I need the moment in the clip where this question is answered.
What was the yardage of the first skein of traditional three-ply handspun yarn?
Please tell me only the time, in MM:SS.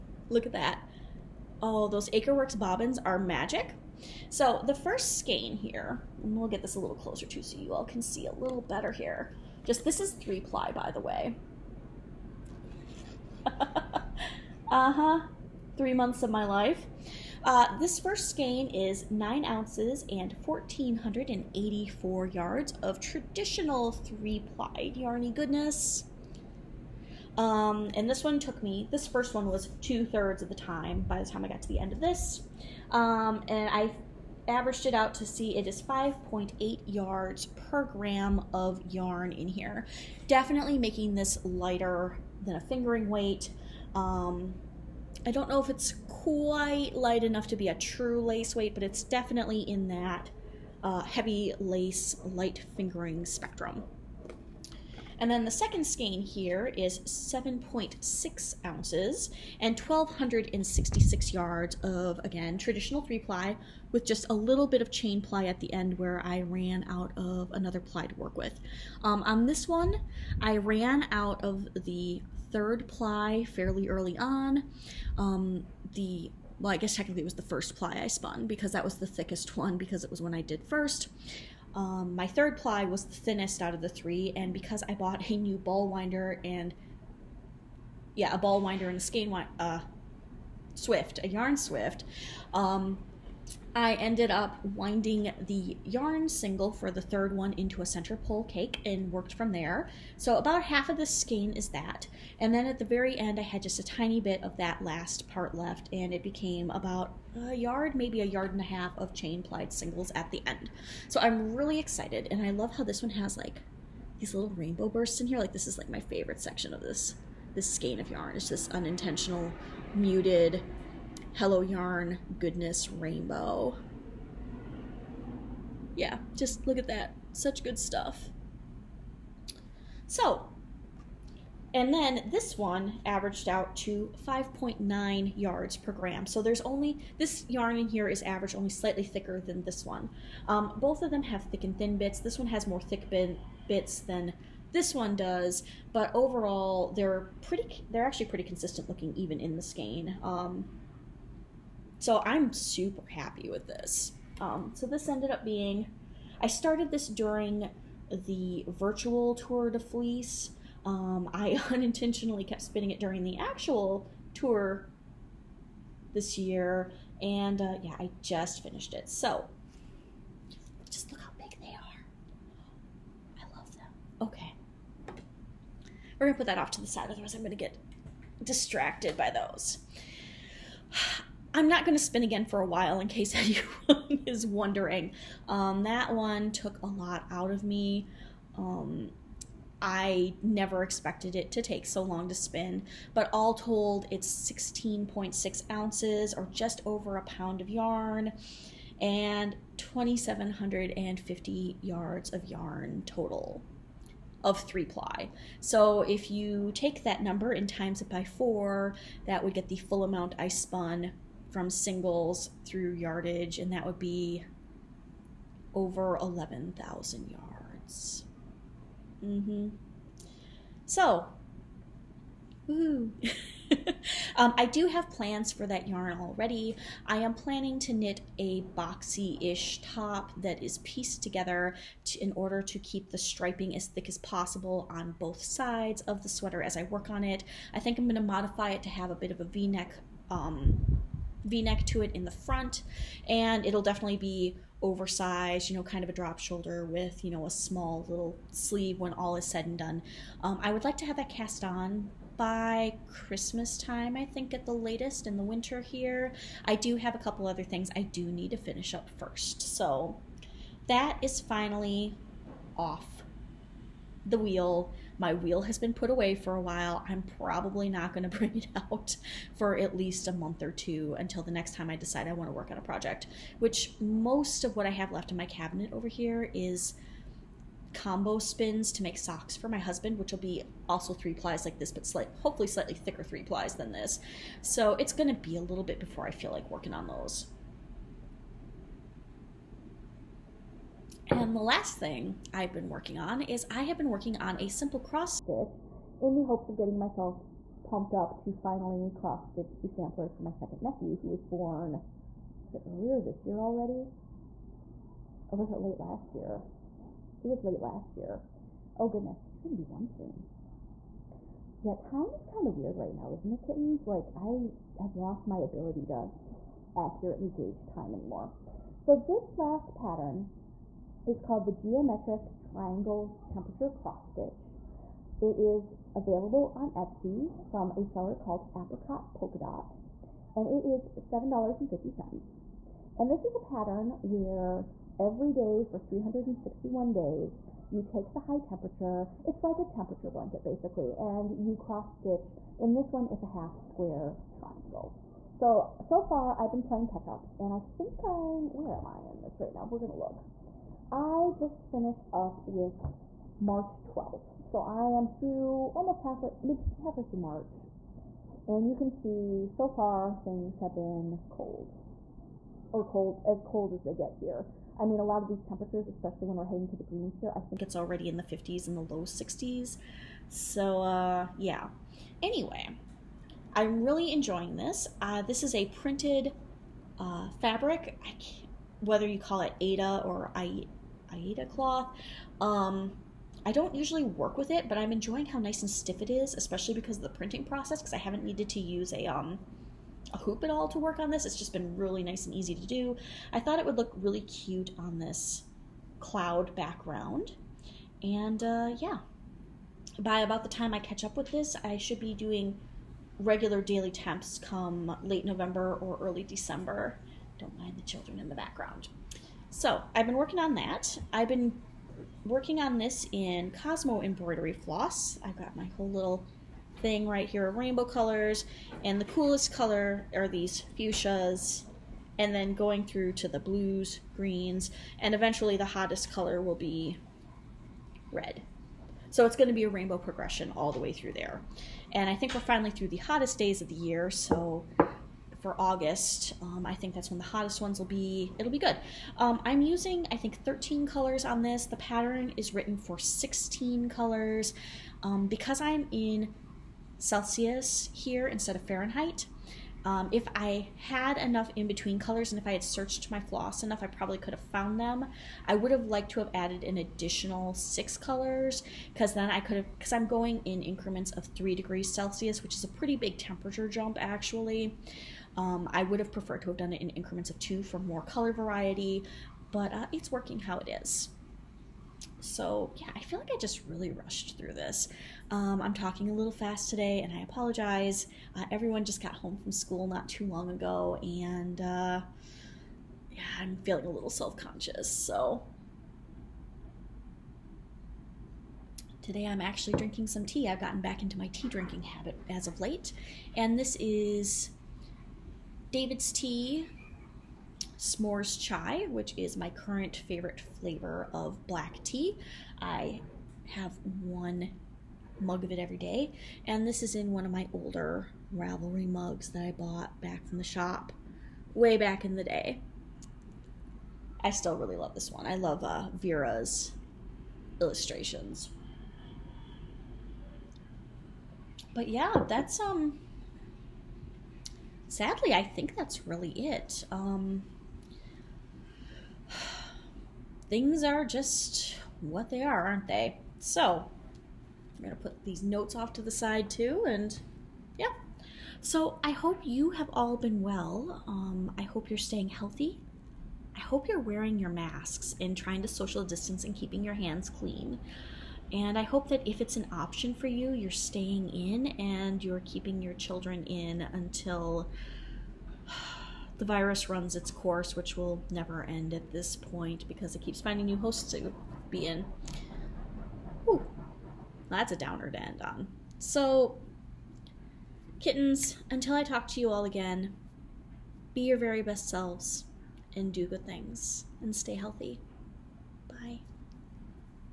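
00:20.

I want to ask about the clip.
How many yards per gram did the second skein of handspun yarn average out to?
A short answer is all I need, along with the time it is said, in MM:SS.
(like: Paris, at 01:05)
5.9, at 02:14.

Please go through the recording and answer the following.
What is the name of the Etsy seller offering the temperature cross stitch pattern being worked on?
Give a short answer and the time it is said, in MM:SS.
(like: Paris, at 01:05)
Apricot Polka Dot, at 05:28.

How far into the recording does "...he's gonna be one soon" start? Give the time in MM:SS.
05:09.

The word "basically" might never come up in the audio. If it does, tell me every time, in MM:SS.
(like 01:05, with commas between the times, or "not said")
05:40.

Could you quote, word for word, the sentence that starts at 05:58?
And you can see so far things have been cold.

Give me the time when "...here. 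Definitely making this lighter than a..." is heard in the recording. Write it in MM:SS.
00:39.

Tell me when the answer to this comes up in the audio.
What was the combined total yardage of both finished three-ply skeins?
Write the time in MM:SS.
03:19.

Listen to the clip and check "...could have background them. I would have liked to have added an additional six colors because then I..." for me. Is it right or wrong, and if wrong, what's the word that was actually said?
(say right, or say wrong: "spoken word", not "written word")
wrong: "found", not "background".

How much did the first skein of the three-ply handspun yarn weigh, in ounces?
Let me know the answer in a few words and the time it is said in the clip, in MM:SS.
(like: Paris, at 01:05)
9 ounces, at 00:19.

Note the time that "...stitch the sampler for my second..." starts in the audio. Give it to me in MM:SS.
04:59.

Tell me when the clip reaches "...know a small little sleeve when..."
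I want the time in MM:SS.
04:07.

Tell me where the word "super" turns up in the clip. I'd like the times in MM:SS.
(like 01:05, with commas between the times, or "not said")
02:32.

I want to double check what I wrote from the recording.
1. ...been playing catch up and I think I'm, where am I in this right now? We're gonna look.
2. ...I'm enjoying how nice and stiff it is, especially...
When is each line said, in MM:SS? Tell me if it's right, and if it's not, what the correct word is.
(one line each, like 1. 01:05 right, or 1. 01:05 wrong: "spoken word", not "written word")
1. 05:46 right
2. 06:24 right.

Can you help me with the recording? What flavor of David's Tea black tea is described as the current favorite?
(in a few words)
S'mores Chai.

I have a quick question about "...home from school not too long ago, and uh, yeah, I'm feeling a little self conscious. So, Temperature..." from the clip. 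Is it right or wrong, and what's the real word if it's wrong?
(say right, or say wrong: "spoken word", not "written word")
wrong: "Today", not "Temperature".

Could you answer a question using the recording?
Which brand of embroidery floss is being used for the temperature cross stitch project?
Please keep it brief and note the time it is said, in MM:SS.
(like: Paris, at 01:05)
Cosmo, at 06:53.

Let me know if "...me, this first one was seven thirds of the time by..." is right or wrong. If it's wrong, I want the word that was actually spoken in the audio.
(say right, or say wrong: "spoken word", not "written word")
wrong: "two", not "seven".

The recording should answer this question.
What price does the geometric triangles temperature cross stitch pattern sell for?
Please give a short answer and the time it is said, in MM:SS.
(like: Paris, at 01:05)
$7.50, at 05:31.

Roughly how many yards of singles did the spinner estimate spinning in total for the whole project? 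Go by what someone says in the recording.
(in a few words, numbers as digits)
over 11,000 yards.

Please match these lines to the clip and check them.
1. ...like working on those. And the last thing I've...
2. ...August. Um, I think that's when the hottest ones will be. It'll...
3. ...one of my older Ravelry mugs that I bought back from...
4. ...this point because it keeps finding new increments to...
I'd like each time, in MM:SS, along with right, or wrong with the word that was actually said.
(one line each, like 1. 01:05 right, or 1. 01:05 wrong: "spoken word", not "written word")
1. 04:46 right
2. 07:15 right
3. 08:27 right
4. 09:19 wrong: "hosts", not "increments".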